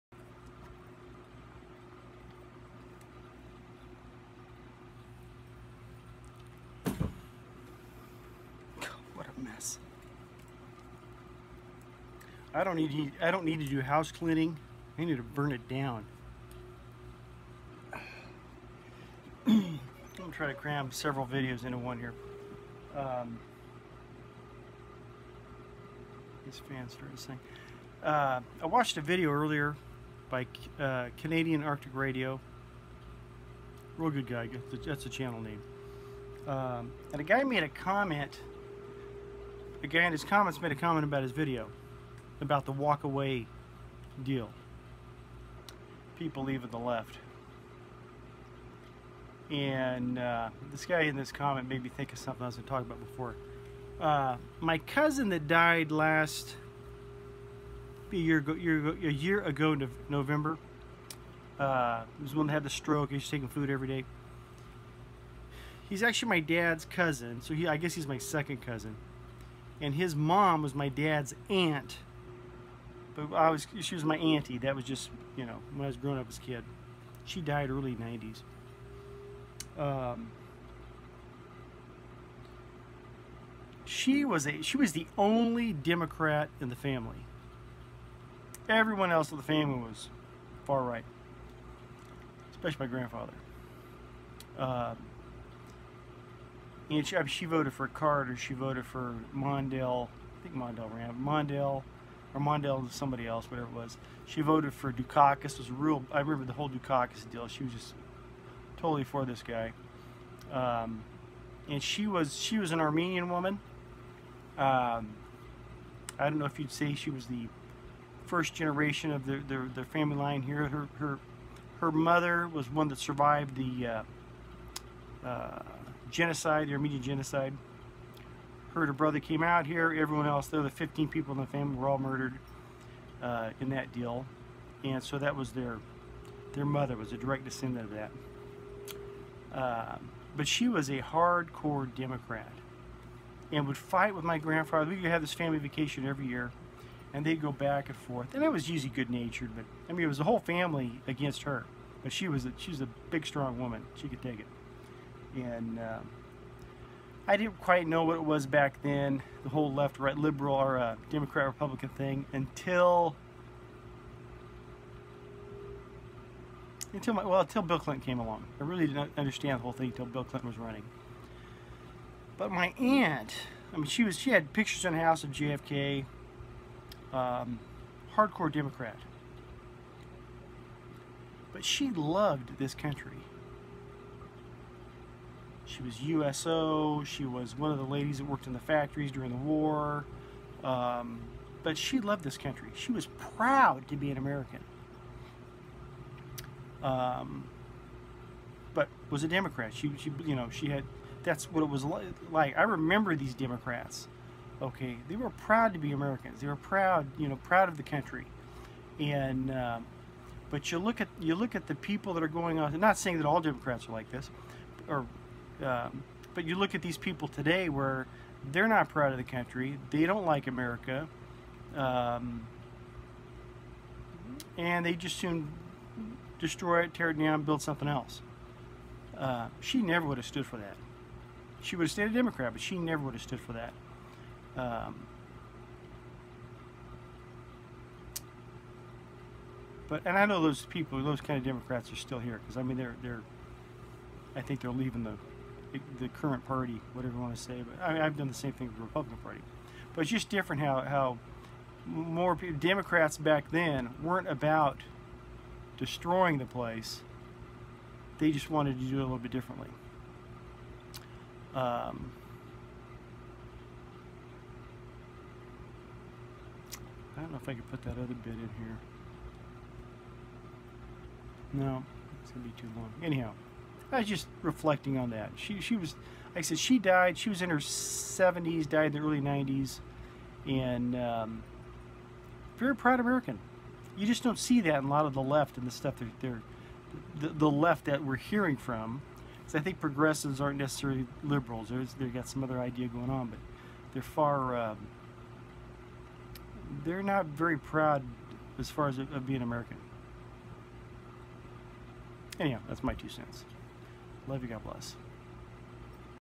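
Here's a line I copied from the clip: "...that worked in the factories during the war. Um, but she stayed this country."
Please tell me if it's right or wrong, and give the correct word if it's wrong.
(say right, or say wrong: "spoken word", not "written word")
wrong: "loved", not "stayed".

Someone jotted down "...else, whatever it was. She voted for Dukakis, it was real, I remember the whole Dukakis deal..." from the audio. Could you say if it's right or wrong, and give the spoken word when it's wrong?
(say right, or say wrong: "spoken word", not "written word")
right.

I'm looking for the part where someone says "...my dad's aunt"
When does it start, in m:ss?
1:10.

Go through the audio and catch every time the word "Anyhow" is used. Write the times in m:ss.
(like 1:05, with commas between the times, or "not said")
4:33, 5:02.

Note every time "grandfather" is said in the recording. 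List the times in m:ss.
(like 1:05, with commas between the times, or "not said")
1:32, 2:24.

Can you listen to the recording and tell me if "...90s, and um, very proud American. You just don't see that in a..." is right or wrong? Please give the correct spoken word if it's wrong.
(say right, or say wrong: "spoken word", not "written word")
right.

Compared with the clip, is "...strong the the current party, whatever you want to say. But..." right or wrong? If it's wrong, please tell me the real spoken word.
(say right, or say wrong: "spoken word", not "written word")
wrong: "leaving", not "strong".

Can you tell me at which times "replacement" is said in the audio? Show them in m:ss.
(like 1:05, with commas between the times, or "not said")
not said.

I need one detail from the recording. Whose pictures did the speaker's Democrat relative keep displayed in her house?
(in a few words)
JFK.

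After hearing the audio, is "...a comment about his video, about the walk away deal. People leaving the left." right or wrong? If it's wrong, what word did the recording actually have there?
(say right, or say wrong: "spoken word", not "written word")
right.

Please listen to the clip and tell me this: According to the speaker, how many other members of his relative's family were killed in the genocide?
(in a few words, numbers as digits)
15.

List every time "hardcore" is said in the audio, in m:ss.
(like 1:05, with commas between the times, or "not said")
2:20, 2:58.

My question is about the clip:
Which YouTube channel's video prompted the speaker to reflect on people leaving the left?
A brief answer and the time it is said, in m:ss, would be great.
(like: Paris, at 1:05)
Canadian Arctic Radio, at 0:31.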